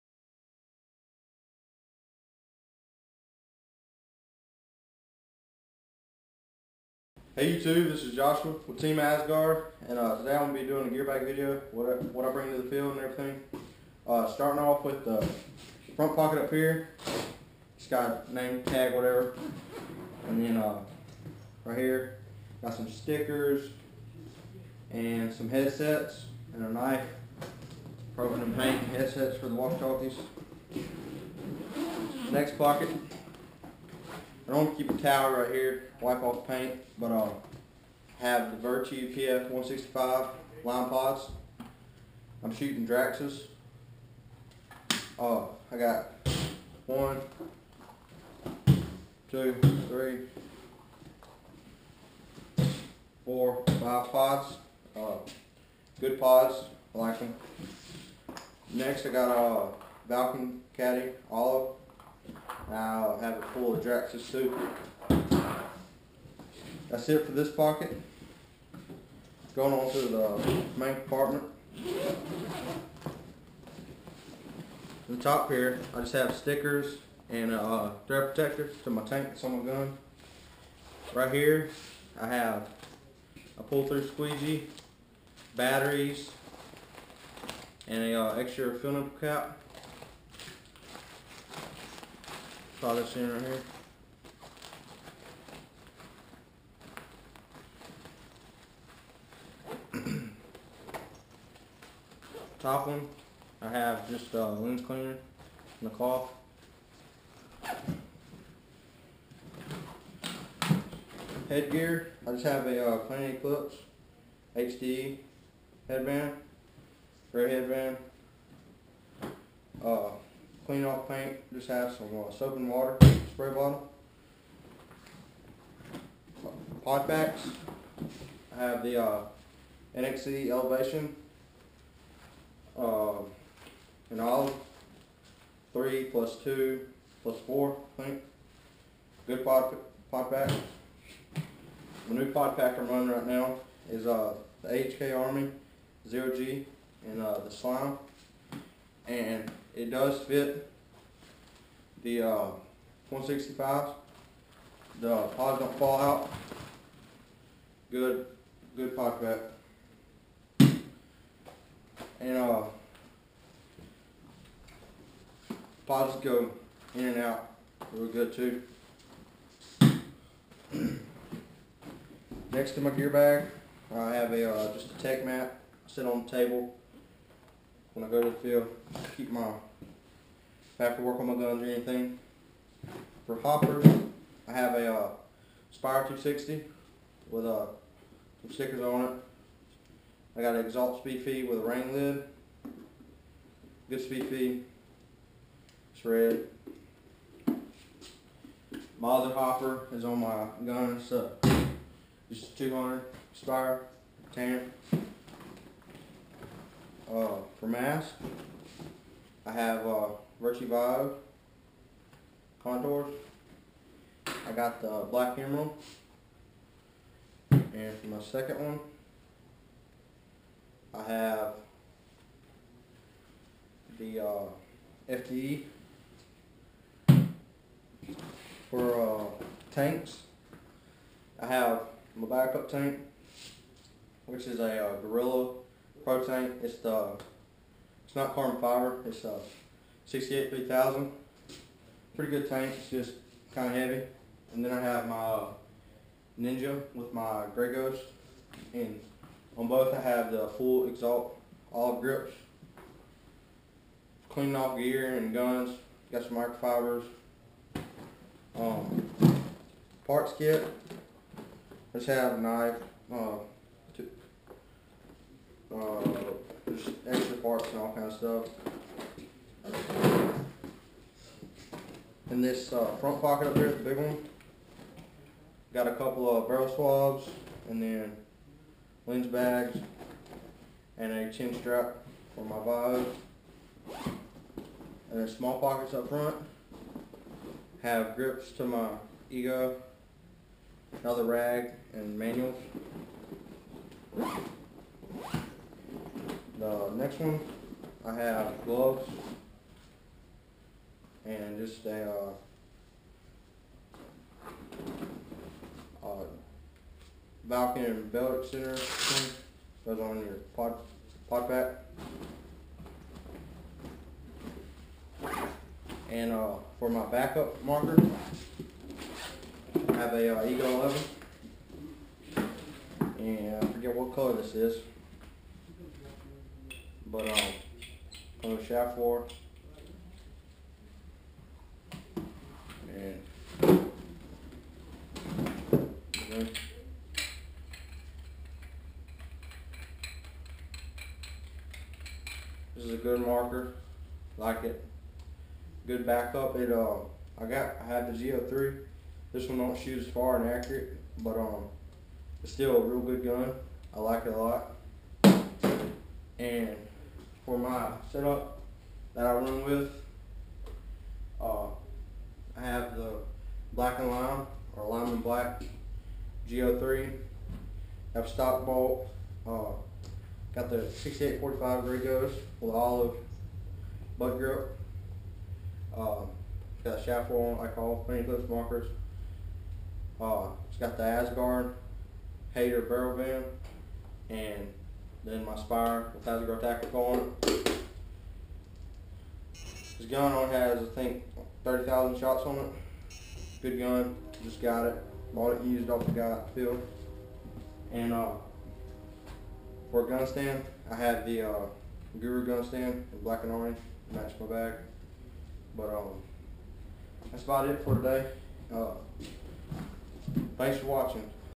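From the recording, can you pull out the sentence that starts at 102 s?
top one, I have just a lens cleaner and a cloth.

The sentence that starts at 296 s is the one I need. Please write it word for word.
The next one, I have gloves and just a uh, uh, Falcon belt extender thing goes on your pod pod pack.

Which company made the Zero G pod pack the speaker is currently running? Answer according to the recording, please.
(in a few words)
HK Army.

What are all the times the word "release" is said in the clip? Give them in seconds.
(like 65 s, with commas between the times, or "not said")
not said.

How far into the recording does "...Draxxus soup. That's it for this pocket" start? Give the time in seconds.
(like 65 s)
63 s.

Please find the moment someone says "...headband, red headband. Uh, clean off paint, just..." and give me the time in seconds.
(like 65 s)
115 s.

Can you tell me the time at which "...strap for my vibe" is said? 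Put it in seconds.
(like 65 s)
281 s.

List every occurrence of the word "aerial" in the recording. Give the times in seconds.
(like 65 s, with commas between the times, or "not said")
not said.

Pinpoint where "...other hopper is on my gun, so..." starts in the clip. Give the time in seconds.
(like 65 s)
199 s.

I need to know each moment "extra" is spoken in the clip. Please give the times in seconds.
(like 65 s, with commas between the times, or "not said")
88 s, 267 s.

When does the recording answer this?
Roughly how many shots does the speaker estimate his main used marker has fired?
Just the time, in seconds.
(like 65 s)
391 s.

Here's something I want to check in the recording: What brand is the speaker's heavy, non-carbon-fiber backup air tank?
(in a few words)
Gorilla.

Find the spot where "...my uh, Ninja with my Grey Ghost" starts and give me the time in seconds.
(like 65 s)
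245 s.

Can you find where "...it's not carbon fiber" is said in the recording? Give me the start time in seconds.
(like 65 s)
238 s.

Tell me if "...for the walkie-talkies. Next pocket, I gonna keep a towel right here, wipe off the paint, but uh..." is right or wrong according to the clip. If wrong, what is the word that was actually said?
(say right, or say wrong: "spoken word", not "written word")
right.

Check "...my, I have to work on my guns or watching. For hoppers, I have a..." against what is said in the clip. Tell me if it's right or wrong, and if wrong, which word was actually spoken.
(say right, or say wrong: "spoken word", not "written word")
wrong: "anything", not "watching".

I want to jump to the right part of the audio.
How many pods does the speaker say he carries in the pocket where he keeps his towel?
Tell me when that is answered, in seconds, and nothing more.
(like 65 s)
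53 s.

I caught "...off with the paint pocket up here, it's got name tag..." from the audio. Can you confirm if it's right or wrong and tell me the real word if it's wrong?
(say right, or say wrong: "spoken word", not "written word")
wrong: "front", not "paint".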